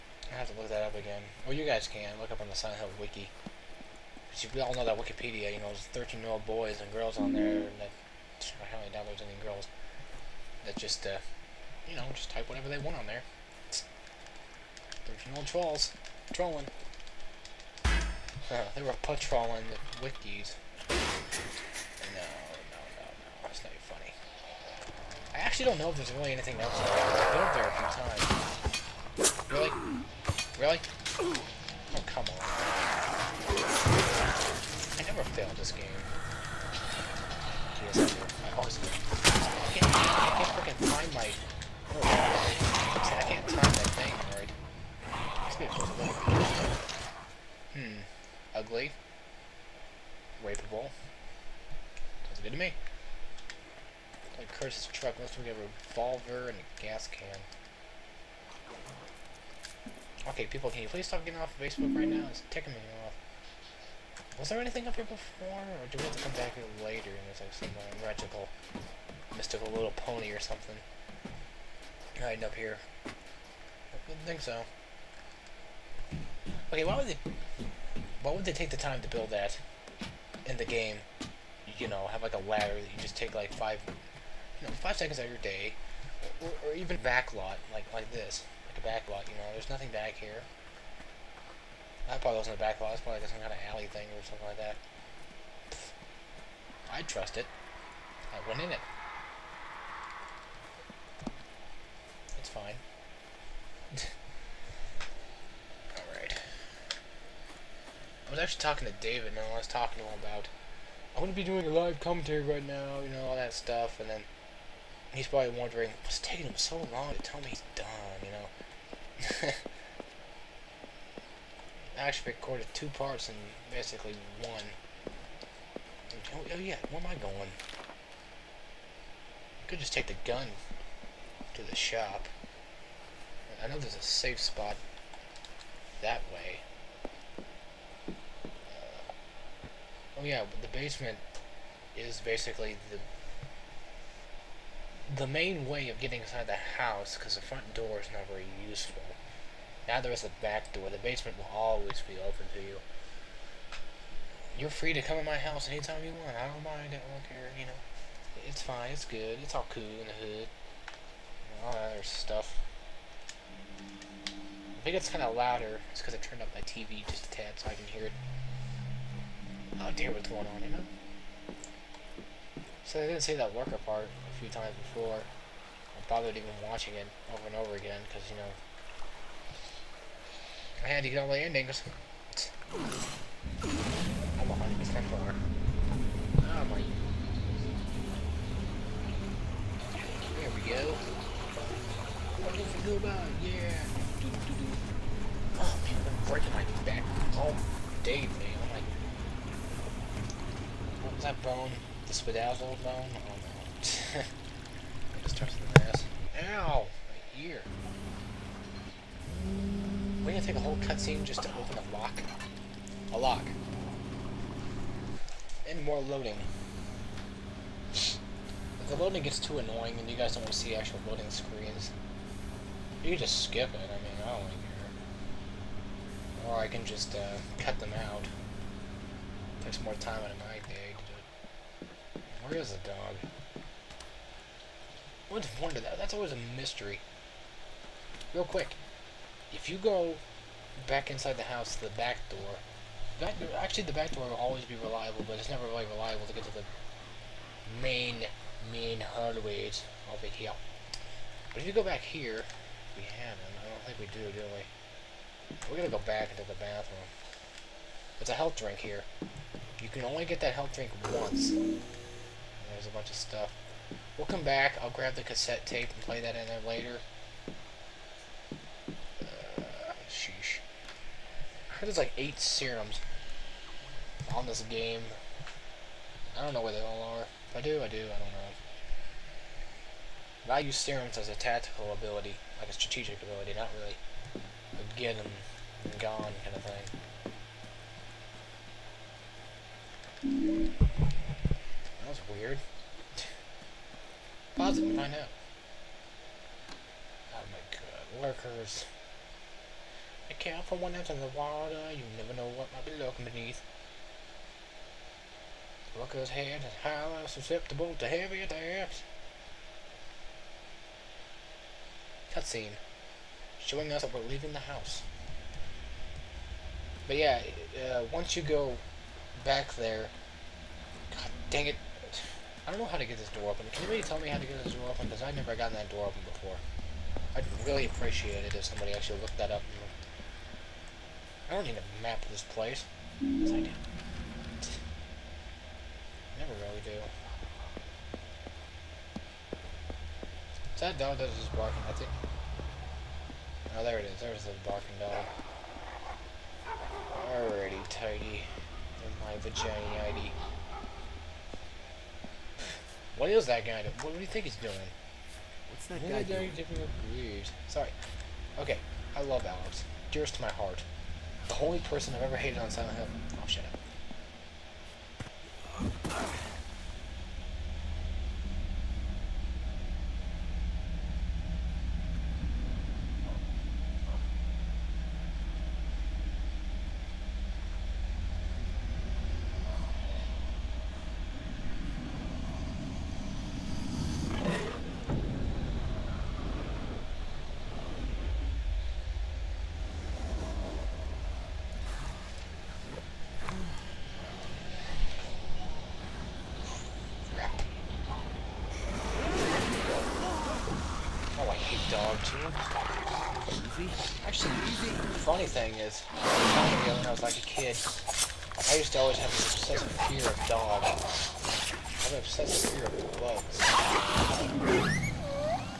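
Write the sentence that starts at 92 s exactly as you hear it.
That probably wasn't a back lot, it's probably like some kind of alley thing or something like that.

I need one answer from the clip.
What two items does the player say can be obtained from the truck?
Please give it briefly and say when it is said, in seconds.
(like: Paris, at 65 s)
a revolver and a gas can, at 55 s.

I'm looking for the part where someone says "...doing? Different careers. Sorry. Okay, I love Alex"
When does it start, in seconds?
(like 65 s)
356 s.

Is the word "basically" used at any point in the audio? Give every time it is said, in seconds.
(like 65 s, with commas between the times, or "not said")
123 s, 142 s.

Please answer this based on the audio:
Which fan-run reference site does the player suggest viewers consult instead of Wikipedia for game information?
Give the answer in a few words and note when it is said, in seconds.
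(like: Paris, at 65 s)
Silent Hill wiki, at 2 s.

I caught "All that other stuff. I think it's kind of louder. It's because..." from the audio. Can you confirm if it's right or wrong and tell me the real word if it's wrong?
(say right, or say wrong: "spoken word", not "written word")
right.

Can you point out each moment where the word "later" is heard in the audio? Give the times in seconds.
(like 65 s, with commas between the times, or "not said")
66 s, 266 s.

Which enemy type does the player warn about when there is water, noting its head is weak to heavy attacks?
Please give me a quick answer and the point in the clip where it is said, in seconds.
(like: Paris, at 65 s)
Lurkers, at 298 s.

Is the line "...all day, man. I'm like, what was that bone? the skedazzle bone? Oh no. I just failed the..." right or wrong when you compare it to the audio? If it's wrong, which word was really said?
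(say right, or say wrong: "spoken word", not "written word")
wrong: "touched", not "failed".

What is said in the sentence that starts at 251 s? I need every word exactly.
But if you go back here, we haven't.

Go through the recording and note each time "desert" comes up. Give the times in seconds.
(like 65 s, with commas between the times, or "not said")
not said.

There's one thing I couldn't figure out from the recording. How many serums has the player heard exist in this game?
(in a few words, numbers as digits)
8.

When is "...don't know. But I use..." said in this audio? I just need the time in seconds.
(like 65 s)
278 s.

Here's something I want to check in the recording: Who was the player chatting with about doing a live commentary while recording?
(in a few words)
David.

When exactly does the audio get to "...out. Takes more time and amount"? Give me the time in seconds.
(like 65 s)
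227 s.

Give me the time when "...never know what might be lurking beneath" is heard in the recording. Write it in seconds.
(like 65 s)
302 s.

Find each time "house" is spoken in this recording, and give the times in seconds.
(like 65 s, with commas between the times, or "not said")
146 s, 155 s, 241 s, 314 s.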